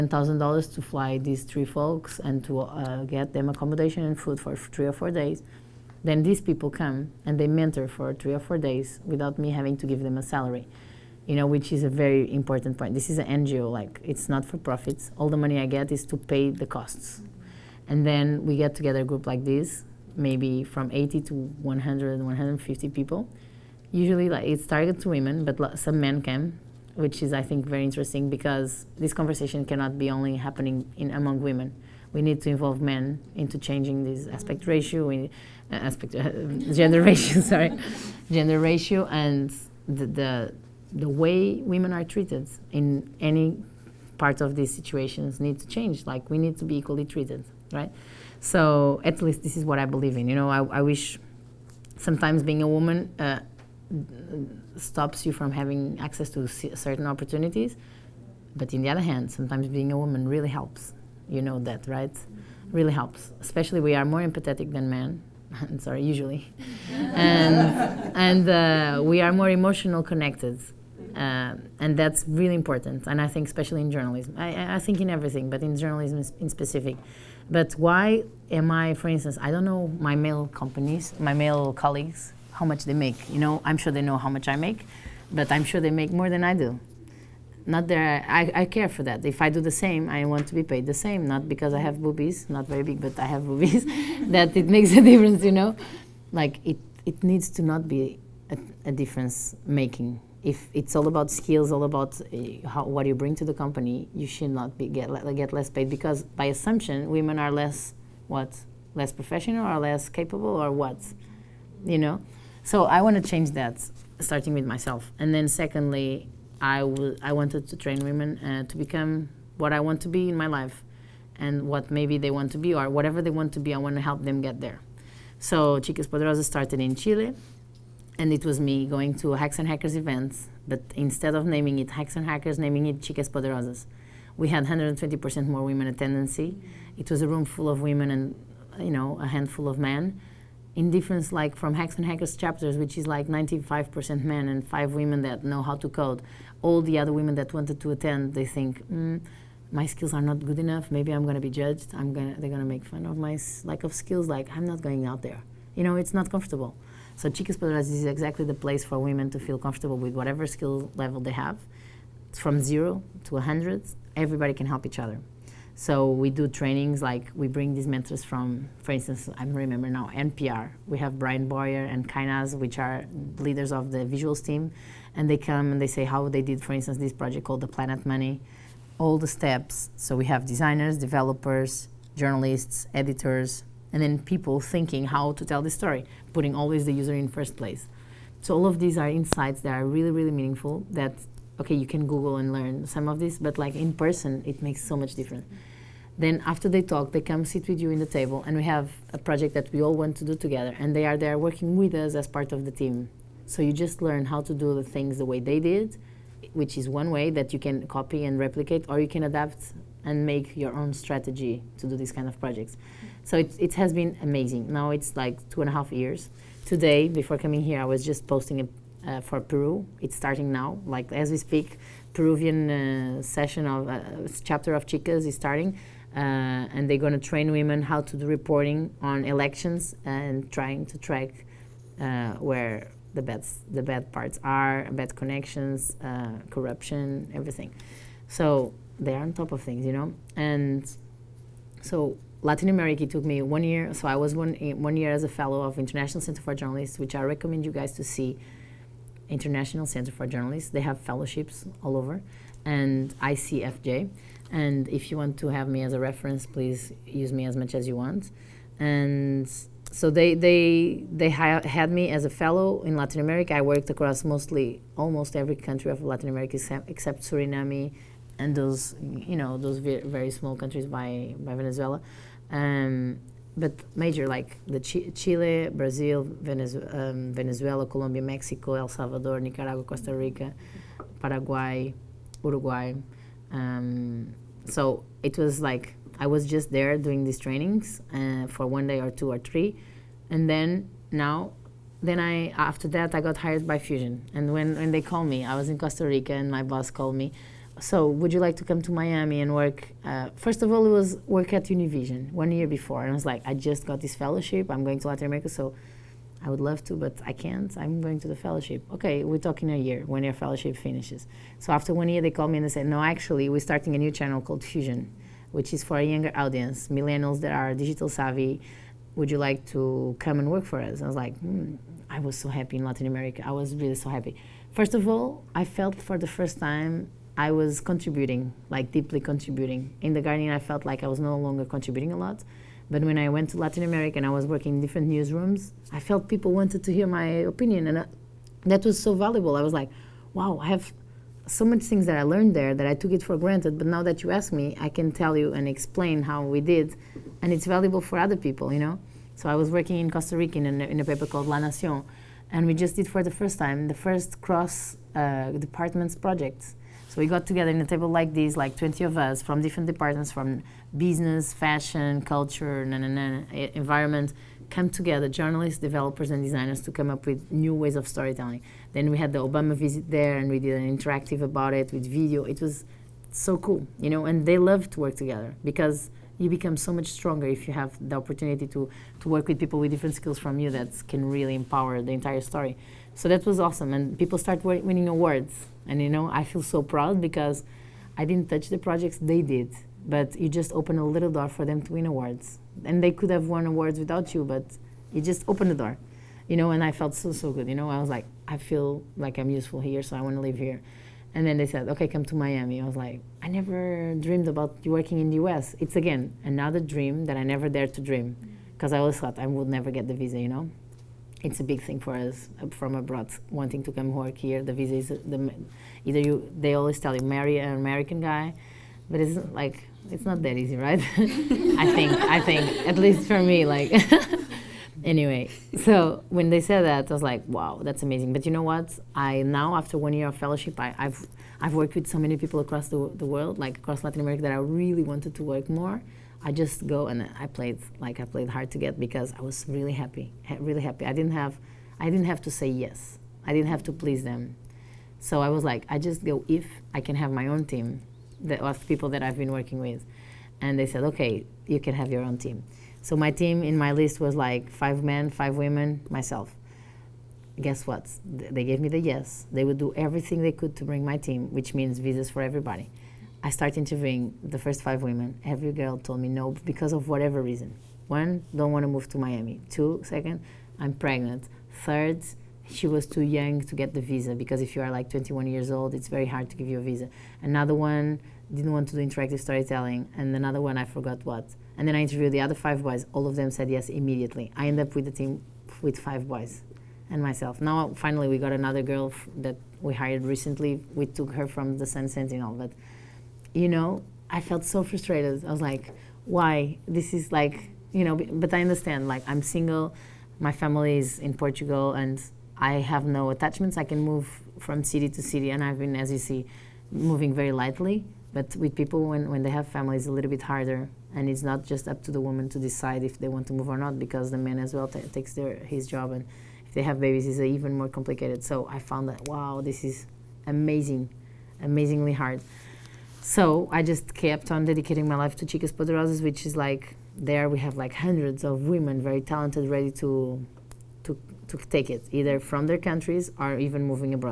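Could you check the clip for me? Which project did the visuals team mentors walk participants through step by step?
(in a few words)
The Planet Money.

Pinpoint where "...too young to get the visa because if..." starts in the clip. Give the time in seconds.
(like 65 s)
473 s.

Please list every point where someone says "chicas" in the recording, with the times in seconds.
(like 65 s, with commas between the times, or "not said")
125 s, 132 s, 157 s, 224 s, 525 s.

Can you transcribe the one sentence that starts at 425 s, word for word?
So when they said that, I was like, wow, that's amazing.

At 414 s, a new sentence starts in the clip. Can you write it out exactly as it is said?
The visa is the, either you they always tell you marry an American guy, but it's like it's not that easy, right?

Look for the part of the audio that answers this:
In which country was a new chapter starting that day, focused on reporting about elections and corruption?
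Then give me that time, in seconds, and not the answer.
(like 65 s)
219 s.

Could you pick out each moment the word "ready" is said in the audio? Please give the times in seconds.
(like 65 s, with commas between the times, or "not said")
529 s.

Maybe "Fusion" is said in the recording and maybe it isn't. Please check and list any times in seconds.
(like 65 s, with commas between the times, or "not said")
293 s, 314 s.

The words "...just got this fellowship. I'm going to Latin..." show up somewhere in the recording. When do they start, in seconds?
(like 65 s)
303 s.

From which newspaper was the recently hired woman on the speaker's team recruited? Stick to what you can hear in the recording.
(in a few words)
Sun Sentinel.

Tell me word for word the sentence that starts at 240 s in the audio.
And so Latin America took me one year.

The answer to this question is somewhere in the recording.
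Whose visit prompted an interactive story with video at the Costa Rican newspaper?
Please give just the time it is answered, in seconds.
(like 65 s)
369 s.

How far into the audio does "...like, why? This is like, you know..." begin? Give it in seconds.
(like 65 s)
495 s.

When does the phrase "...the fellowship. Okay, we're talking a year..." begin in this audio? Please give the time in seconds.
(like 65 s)
308 s.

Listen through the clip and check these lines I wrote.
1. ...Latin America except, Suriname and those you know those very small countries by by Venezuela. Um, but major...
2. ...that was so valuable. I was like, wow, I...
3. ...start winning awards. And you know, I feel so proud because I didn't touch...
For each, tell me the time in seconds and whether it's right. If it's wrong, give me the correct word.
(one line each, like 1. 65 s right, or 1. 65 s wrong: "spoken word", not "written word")
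1. 266 s right
2. 338 s right
3. 384 s right.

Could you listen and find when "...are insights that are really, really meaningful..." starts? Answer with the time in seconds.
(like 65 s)
188 s.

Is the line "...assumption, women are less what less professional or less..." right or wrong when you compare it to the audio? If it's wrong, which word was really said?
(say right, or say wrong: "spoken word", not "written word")
right.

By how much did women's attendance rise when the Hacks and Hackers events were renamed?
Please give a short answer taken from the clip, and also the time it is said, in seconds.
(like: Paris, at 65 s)
120%, at 134 s.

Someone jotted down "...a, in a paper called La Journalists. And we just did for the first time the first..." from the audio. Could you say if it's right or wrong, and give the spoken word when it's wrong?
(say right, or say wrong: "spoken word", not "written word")
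wrong: "Nación", not "Journalists".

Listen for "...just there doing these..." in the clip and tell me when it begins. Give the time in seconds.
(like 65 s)
286 s.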